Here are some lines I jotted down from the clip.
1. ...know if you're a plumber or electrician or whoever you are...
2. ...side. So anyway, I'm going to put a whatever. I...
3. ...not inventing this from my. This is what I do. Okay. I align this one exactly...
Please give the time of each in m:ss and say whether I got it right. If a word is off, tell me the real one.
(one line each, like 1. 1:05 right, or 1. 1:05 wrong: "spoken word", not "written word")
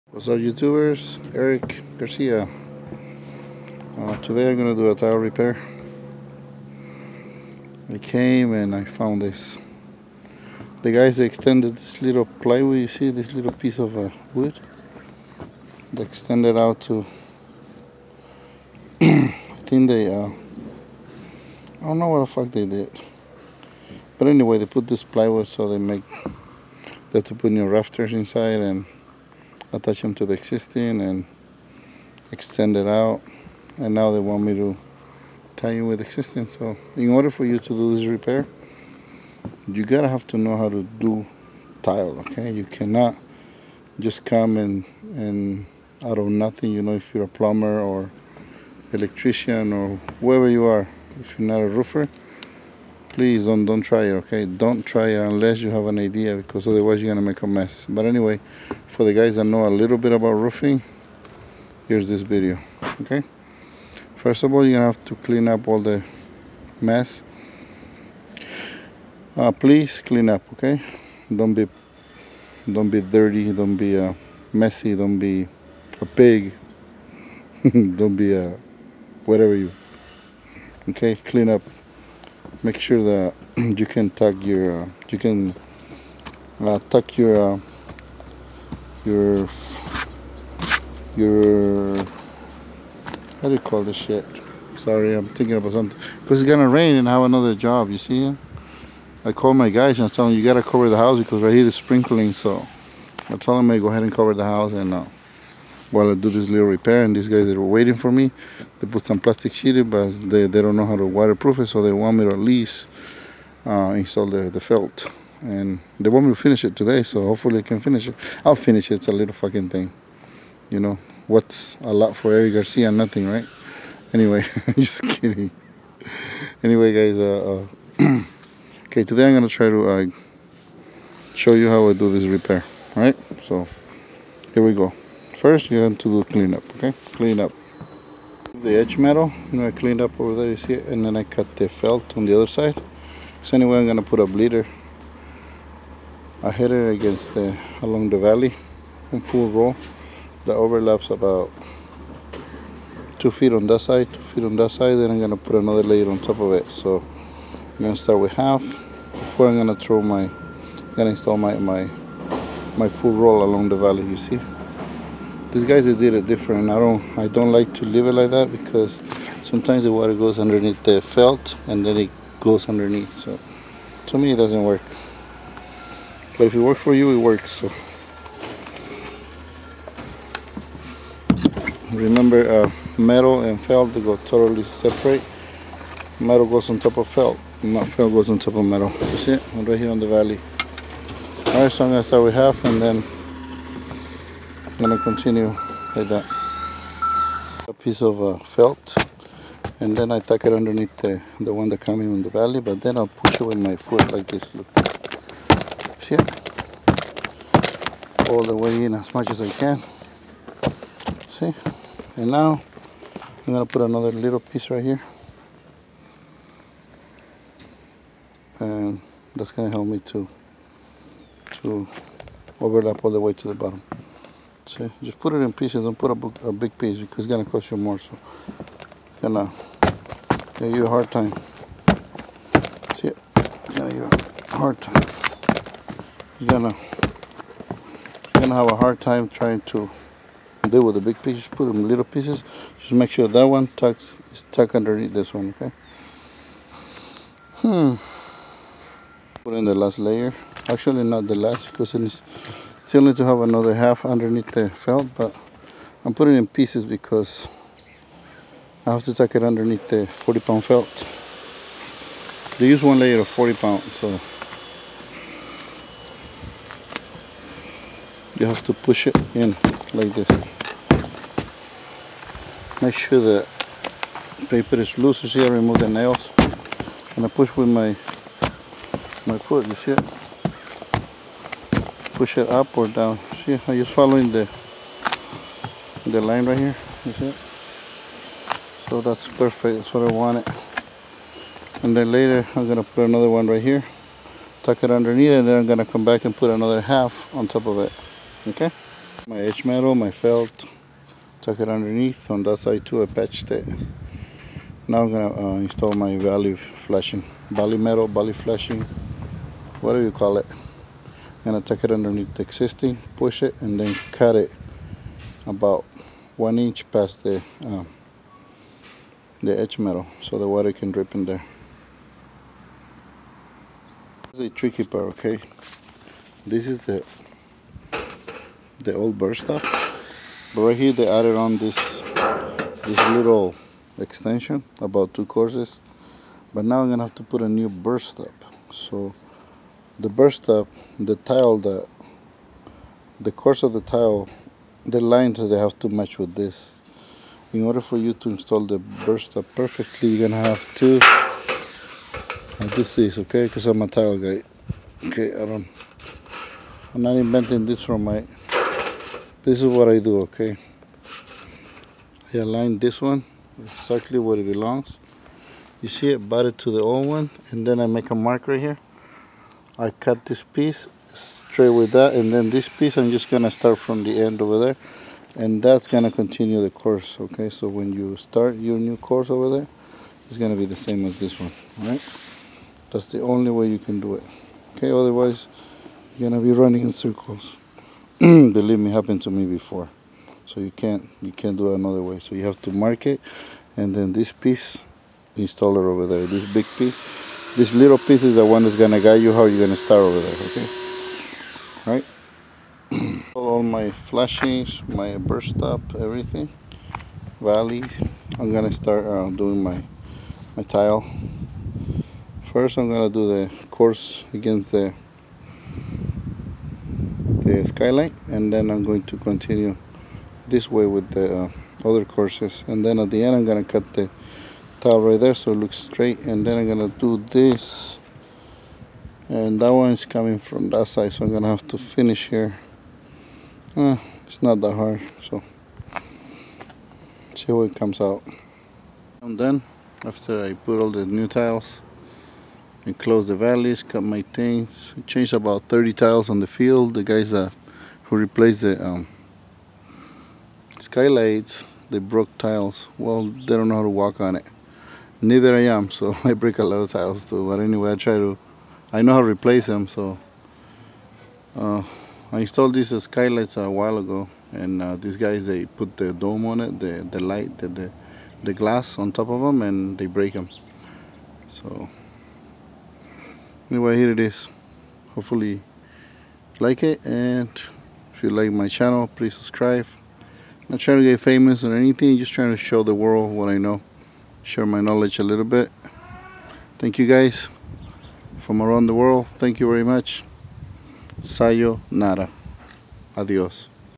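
1. 0:46 right
2. 2:22 wrong: "bleeder", not "whatever"
3. 5:57 right.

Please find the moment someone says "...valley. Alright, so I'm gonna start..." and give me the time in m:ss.
3:10.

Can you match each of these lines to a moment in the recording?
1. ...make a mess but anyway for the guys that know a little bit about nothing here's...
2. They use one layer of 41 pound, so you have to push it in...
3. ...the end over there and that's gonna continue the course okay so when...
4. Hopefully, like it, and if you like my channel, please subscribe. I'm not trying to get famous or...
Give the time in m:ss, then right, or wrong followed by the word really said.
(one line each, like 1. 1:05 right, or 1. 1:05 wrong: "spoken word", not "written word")
1. 0:57 wrong: "roofing", not "nothing"
2. 4:22 wrong: "40", not "41"
3. 6:14 right
4. 7:55 right.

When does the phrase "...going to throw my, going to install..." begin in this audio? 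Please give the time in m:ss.
2:39.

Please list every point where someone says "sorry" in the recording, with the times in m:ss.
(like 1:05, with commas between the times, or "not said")
1:34.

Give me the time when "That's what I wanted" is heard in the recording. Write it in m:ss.
4:49.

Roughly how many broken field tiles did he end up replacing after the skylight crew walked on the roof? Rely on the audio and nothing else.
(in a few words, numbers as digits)
30.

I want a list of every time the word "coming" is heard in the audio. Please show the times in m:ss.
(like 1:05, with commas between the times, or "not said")
3:21, 7:10.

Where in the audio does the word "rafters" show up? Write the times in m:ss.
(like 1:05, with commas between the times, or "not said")
0:27.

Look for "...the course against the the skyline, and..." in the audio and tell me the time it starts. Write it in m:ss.
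6:53.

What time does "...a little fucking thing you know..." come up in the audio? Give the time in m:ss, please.
1:59.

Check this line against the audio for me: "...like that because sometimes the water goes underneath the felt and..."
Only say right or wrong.
right.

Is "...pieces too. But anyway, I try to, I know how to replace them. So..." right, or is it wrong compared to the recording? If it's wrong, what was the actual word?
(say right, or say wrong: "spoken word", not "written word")
wrong: "tiles", not "pieces".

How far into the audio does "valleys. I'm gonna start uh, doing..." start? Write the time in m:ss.
6:47.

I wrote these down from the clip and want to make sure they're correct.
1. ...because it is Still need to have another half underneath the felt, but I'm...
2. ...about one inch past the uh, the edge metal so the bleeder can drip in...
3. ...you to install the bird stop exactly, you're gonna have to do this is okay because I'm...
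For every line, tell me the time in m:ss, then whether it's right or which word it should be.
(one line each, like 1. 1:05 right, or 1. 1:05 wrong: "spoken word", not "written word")
1. 4:11 right
2. 5:15 wrong: "water", not "bleeder"
3. 5:47 wrong: "perfectly", not "exactly".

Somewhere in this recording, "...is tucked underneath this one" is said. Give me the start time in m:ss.
4:04.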